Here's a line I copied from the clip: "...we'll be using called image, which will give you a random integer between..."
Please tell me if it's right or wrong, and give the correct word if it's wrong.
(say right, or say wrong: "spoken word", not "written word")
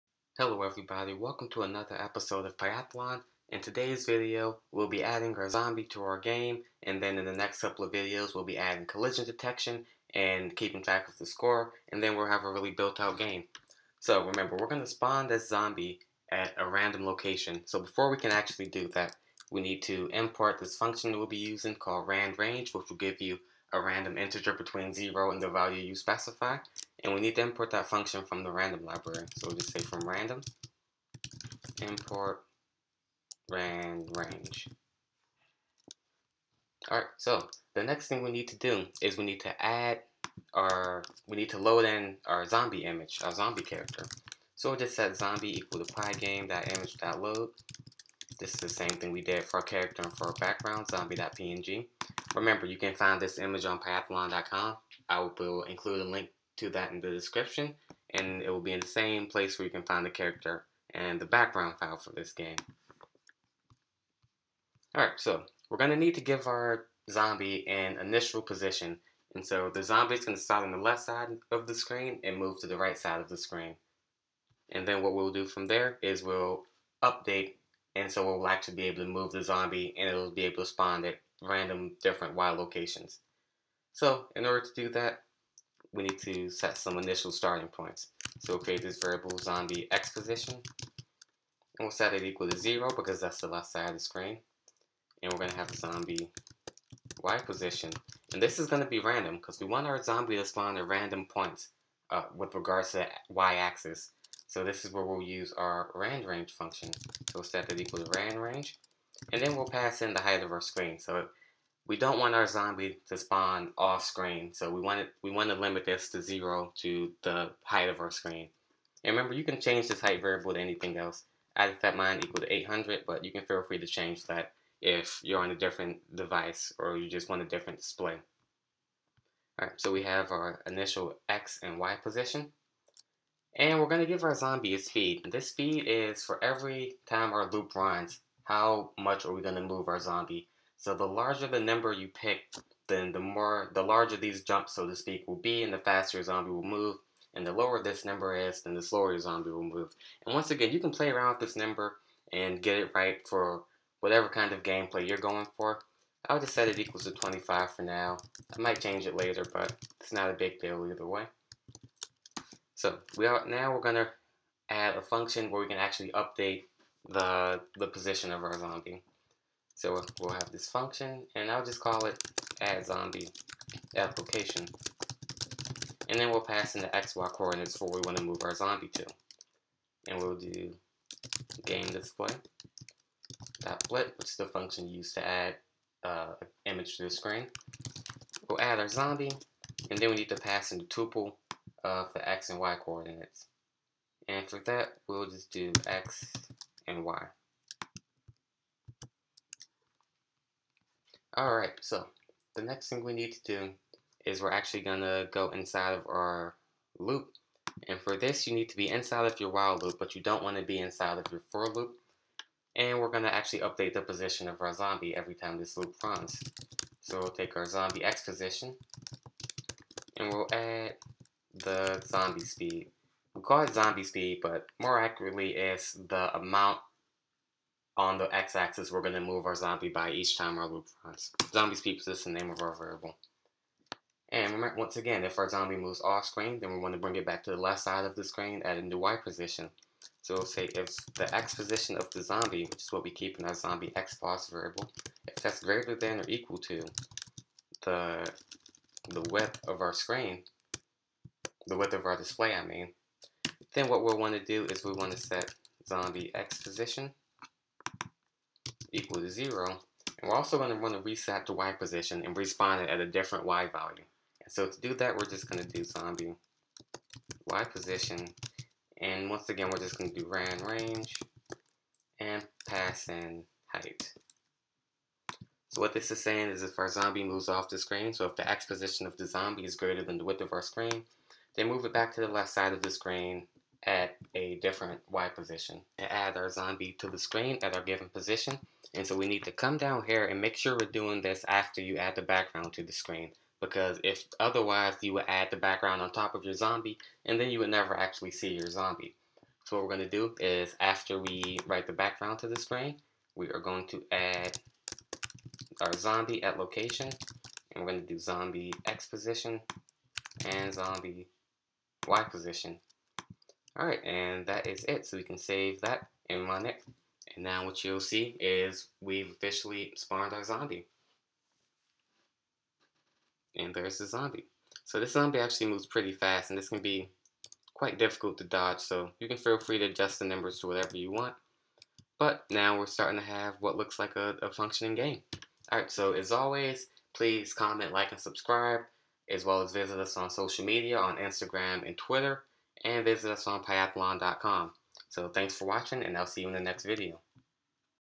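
wrong: "randrange", not "image".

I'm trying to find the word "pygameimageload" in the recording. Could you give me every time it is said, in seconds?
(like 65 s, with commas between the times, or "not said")
45 s.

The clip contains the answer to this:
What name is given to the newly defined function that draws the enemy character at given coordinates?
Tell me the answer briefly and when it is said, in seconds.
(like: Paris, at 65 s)
add zombie at location, at 172 s.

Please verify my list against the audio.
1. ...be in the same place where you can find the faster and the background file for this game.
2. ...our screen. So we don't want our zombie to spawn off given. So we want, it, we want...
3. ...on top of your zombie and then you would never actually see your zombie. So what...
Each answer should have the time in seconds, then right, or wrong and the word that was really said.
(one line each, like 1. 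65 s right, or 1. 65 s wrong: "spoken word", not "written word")
1. 58 s wrong: "character", not "faster"
2. 110 s wrong: "screen", not "given"
3. 296 s right.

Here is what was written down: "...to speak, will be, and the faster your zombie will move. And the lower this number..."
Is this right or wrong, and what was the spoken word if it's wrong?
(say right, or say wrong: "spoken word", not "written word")
right.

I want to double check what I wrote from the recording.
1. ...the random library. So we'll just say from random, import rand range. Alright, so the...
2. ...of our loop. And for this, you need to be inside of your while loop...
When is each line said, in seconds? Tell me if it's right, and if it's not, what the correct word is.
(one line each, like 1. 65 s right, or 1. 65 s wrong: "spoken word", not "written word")
1. 28 s right
2. 205 s right.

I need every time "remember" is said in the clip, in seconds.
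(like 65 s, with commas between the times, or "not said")
14 s, 52 s, 119 s, 234 s.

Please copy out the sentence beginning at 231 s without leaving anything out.
Zombie speed is just the name of our variable.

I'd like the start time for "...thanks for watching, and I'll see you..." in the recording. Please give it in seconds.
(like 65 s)
345 s.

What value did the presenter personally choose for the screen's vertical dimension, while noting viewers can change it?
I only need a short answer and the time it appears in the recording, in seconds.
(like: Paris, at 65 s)
800, at 122 s.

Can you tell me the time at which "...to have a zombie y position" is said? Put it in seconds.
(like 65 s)
95 s.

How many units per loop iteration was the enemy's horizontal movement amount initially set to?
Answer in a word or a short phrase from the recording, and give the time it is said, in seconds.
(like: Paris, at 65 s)
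25, at 157 s.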